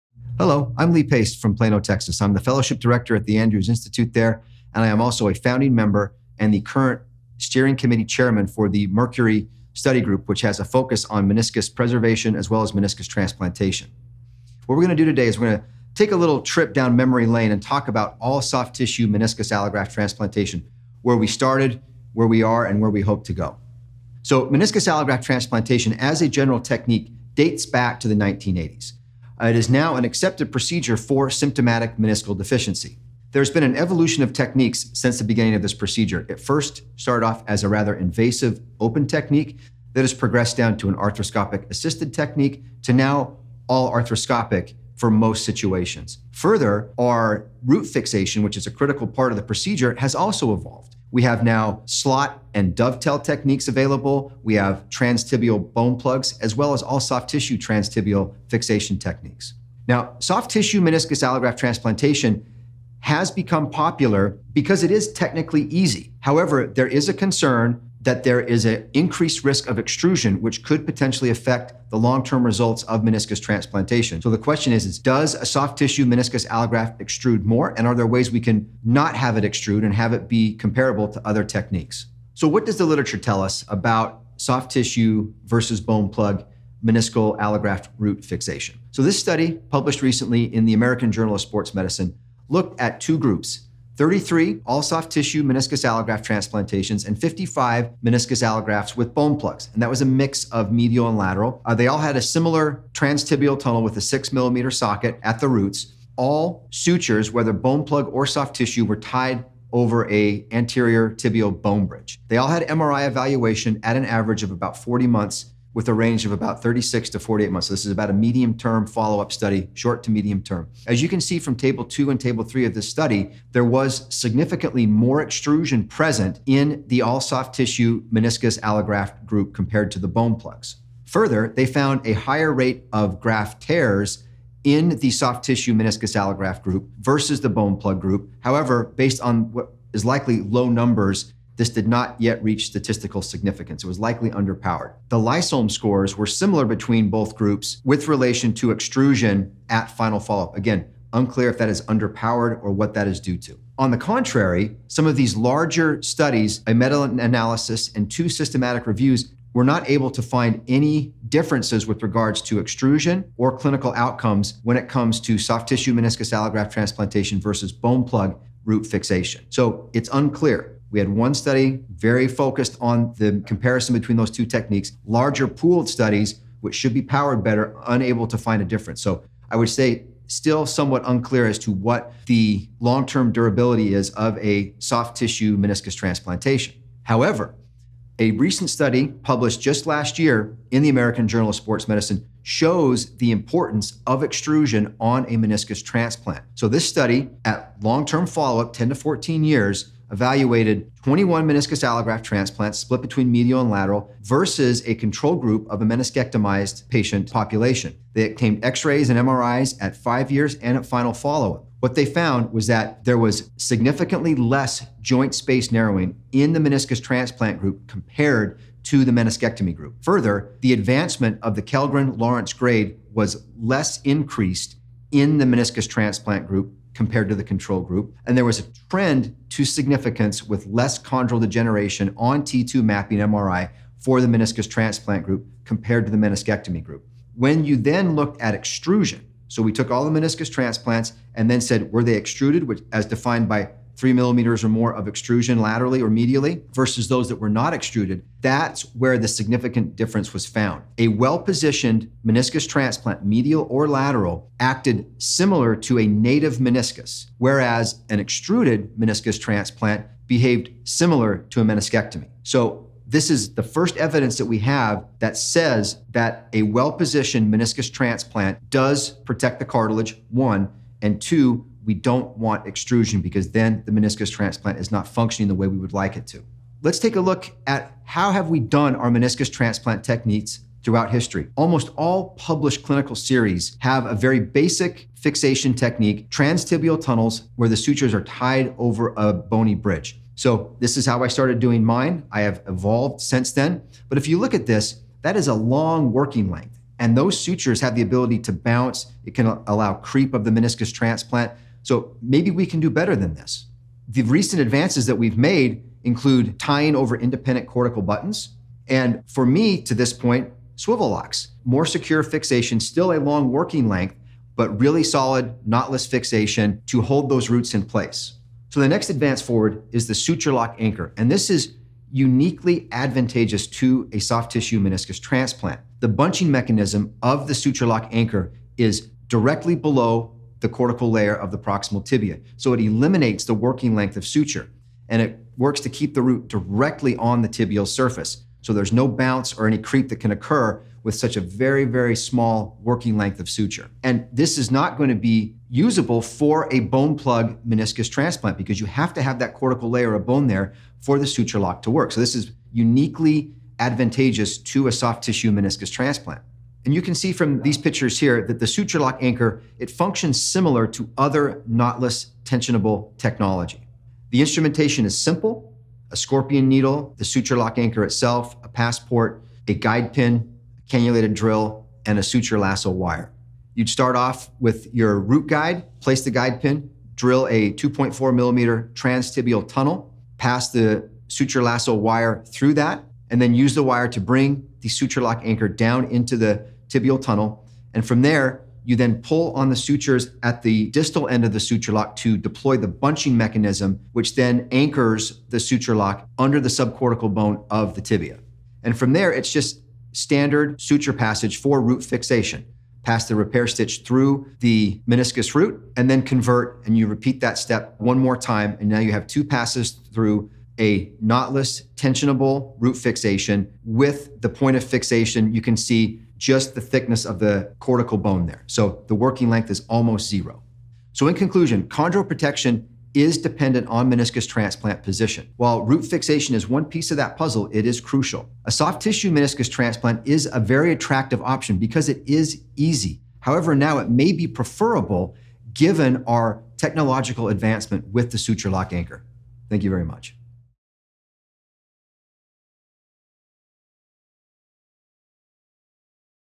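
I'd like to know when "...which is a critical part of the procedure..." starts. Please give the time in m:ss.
0:48.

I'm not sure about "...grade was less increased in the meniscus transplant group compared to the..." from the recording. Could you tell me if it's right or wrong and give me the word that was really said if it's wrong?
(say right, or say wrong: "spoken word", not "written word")
right.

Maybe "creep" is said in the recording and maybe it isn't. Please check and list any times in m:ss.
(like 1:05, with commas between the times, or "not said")
4:59, 5:39.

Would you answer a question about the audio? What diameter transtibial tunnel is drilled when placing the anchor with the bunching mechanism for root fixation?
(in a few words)
2.4 millimeters.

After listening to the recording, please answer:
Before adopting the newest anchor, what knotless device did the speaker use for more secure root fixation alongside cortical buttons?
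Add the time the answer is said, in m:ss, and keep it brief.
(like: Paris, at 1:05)
SwiveLocks, at 5:10.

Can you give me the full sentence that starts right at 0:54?
We have transtibial bone plugs, as well as all soft tissue transtibial fixation techniques.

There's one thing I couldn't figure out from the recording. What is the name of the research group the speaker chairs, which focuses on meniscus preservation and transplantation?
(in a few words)
Mercury Study Group.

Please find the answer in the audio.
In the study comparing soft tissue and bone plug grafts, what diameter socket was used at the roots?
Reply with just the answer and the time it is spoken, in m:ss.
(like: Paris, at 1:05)
6 millimeters, at 1:44.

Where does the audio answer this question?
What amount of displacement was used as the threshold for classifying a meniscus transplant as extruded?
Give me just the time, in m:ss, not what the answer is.
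4:03.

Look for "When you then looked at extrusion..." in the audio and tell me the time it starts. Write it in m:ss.
3:57.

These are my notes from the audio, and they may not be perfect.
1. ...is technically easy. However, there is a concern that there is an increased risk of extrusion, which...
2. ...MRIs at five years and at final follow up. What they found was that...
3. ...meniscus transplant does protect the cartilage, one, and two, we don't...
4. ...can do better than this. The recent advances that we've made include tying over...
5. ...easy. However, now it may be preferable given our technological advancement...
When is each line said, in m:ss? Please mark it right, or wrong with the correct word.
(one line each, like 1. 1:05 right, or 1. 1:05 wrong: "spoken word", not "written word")
1. 1:04 right
2. 3:29 right
3. 4:27 right
4. 5:02 right
5. 7:12 right.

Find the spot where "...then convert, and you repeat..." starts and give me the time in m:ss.
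6:46.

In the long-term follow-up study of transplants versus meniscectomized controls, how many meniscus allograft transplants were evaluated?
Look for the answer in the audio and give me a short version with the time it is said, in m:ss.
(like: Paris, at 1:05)
21, at 3:21.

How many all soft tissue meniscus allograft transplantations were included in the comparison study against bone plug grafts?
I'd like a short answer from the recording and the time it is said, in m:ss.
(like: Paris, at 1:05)
33, at 1:34.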